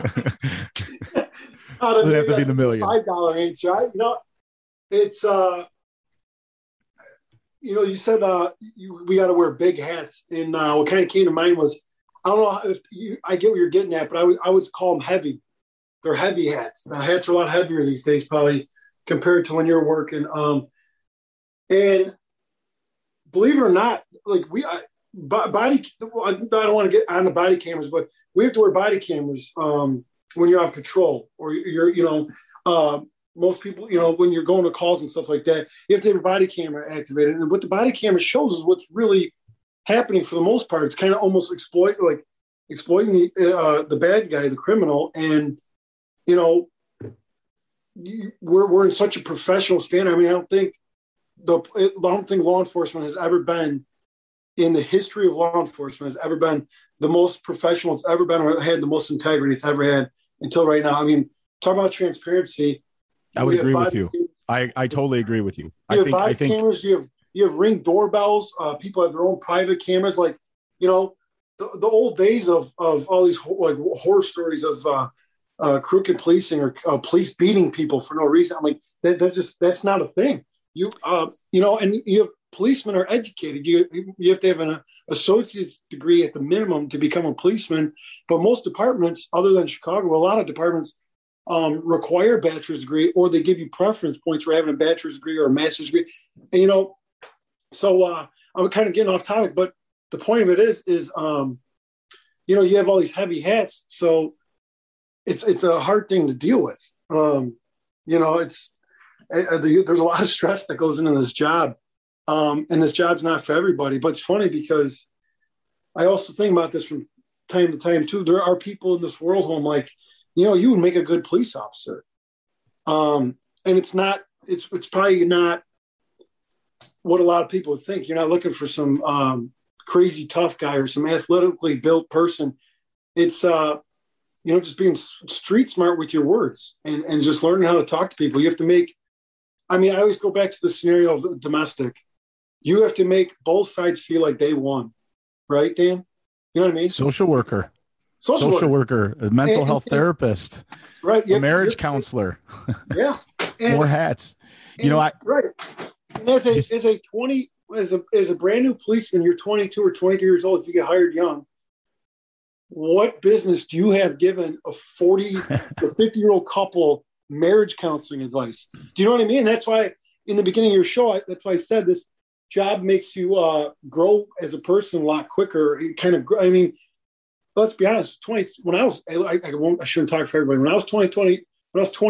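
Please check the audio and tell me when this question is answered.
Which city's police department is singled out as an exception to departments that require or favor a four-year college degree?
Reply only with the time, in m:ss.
1:29.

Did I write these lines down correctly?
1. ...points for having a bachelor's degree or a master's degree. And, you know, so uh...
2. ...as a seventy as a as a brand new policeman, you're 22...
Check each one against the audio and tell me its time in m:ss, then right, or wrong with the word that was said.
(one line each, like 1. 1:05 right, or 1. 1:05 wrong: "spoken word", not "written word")
1. 1:34 right
2. 2:36 wrong: "twenty", not "seventy".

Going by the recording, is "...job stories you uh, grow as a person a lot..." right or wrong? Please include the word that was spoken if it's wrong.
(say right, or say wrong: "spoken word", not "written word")
wrong: "makes", not "stories".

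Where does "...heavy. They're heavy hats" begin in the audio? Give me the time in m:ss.
0:15.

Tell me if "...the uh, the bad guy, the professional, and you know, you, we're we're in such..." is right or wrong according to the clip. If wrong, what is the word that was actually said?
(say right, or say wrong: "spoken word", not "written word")
wrong: "criminal", not "professional".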